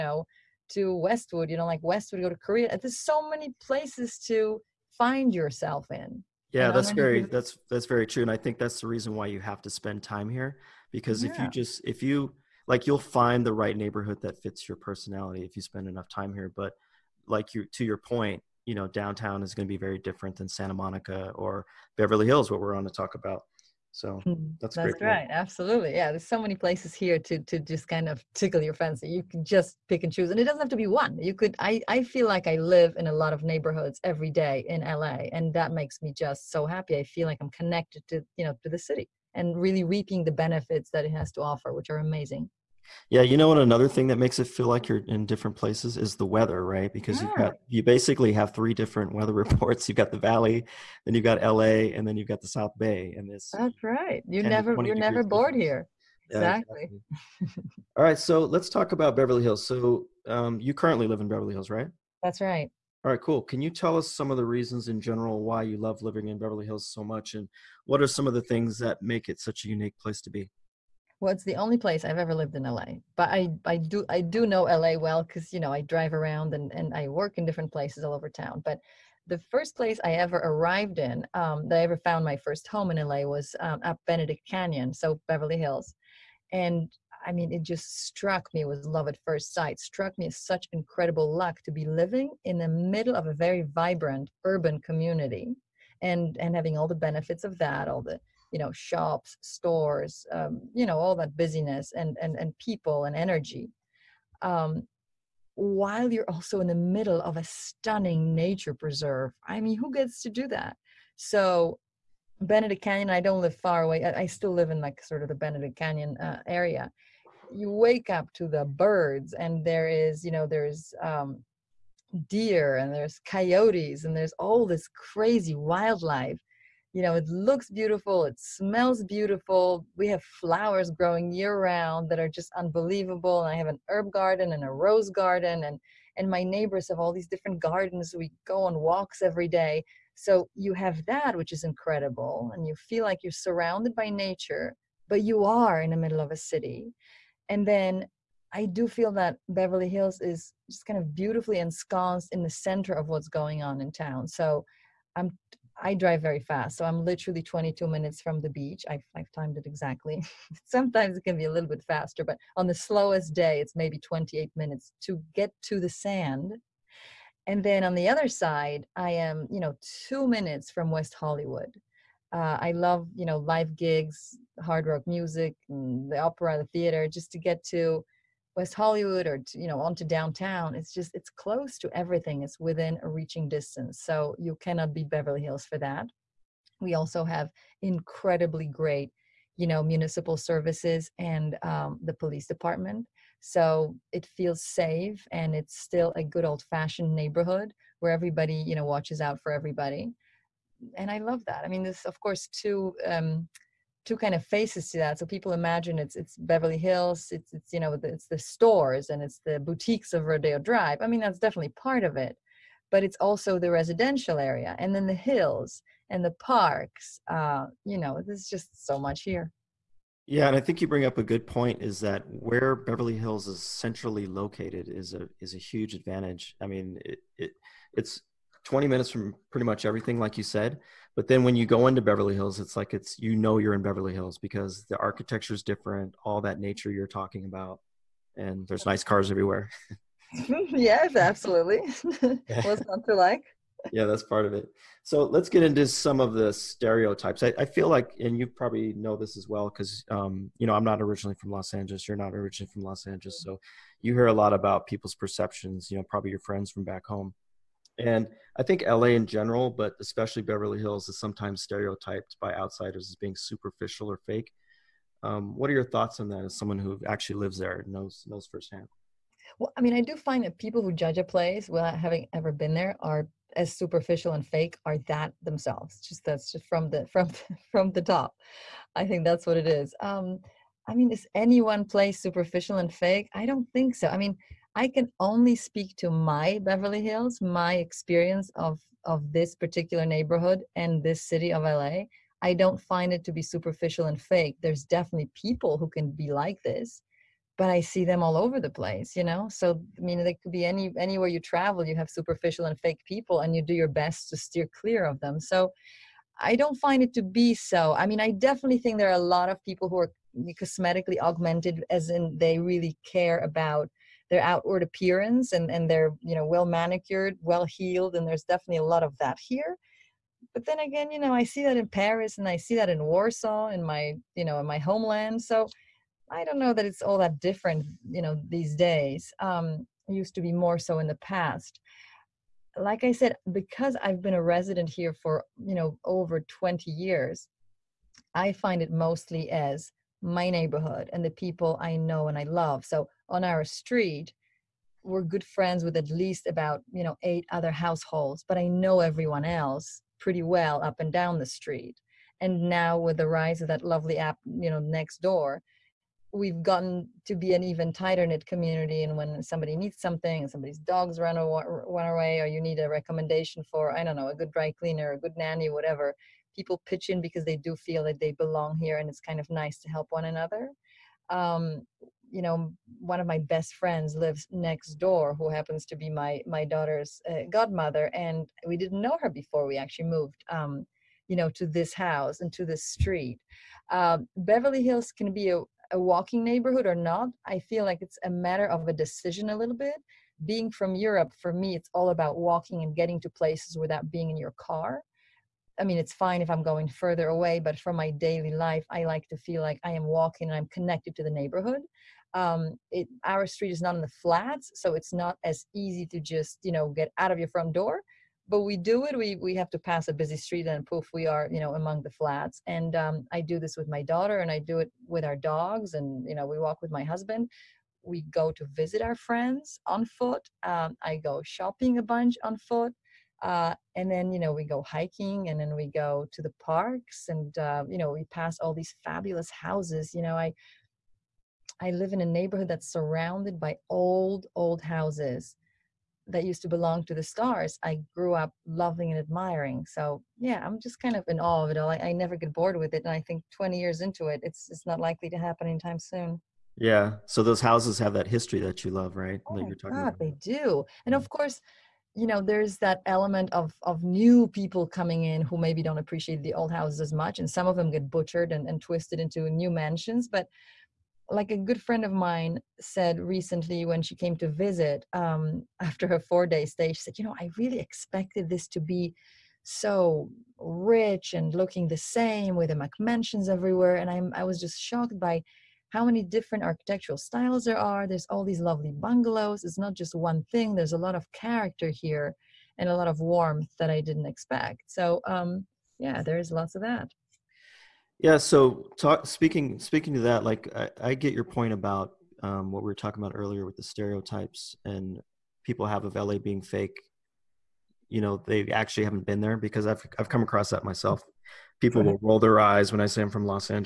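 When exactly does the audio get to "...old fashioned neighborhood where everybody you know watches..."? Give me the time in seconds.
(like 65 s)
196 s.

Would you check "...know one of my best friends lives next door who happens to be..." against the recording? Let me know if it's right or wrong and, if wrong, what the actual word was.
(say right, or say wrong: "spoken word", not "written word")
right.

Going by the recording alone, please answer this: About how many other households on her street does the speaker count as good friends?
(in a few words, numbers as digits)
8.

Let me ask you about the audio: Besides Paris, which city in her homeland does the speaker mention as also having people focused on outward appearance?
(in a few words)
Warsaw.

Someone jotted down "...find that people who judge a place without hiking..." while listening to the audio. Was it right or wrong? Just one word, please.
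wrong.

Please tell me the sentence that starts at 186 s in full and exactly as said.
We also have incredibly great you know municipal services and um, the police department.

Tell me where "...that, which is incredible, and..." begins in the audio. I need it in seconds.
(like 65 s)
141 s.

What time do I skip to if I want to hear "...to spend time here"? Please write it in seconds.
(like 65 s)
9 s.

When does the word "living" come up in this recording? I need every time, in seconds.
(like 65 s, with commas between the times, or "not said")
66 s, 91 s.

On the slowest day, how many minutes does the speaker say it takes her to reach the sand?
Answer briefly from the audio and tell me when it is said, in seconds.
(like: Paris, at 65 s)
28, at 163 s.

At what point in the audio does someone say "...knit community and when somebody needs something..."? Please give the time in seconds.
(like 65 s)
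358 s.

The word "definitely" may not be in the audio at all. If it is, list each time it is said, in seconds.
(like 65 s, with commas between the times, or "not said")
211 s, 294 s, 308 s, 318 s.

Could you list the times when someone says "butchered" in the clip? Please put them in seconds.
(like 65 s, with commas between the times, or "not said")
458 s.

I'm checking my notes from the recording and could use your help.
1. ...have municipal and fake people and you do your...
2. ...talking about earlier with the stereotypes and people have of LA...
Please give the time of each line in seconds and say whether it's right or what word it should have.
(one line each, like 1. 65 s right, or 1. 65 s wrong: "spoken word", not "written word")
1. 301 s wrong: "superficial", not "municipal"
2. 492 s right.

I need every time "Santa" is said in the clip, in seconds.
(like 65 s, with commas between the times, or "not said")
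20 s.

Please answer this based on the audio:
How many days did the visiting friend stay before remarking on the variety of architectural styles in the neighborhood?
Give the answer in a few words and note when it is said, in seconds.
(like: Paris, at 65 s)
4, at 466 s.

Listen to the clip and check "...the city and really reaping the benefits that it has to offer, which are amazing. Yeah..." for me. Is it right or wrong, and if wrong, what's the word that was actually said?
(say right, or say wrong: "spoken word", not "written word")
right.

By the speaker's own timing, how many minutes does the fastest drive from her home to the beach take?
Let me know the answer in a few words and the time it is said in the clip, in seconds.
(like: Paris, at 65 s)
22, at 157 s.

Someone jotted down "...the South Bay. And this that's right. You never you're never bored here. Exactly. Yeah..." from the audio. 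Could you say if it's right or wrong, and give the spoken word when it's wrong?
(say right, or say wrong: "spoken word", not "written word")
right.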